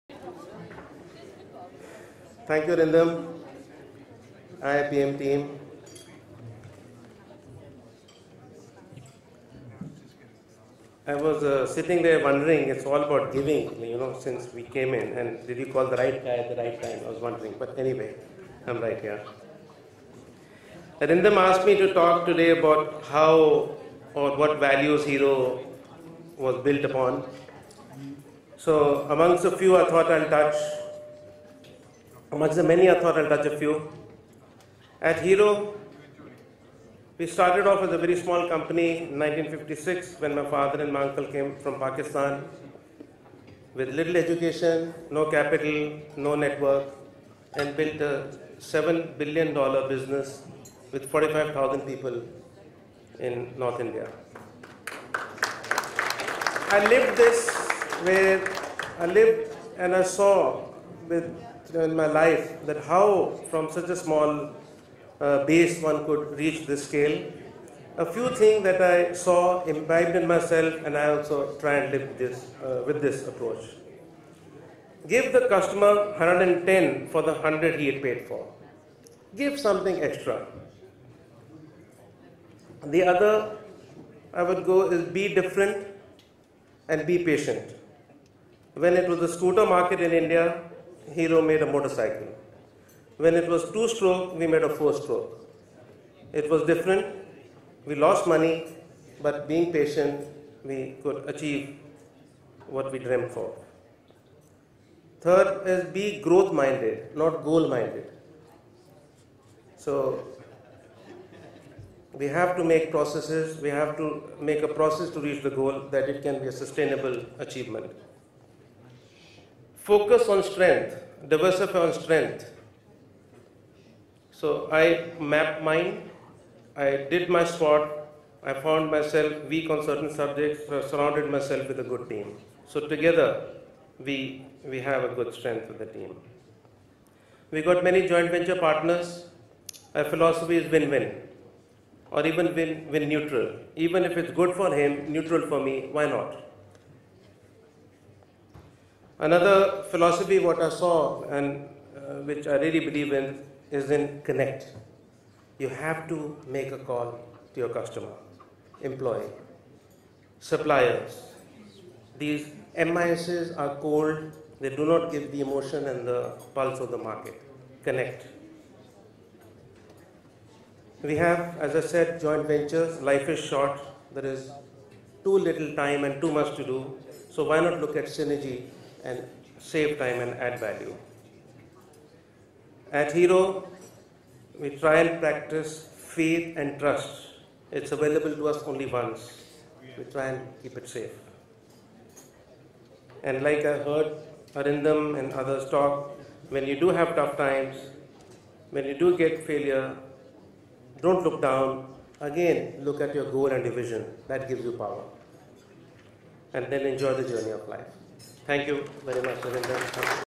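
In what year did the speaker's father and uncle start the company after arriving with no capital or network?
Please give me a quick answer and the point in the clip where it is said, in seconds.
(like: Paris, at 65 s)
1956, at 39 s.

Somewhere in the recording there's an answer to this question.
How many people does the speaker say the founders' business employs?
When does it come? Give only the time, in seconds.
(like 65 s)
51 s.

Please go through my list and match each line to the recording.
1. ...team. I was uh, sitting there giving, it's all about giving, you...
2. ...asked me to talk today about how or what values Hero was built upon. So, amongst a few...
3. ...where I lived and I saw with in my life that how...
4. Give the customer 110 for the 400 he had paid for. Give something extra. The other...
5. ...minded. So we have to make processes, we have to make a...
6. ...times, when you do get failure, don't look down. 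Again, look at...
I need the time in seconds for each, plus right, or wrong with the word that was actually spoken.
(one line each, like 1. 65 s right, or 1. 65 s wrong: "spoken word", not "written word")
1. 5 s wrong: "wondering", not "giving"
2. 21 s right
3. 58 s right
4. 75 s wrong: "100", not "400"
5. 107 s right
6. 197 s right.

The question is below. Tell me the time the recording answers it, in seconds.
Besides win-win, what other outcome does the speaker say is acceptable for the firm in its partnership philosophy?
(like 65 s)
142 s.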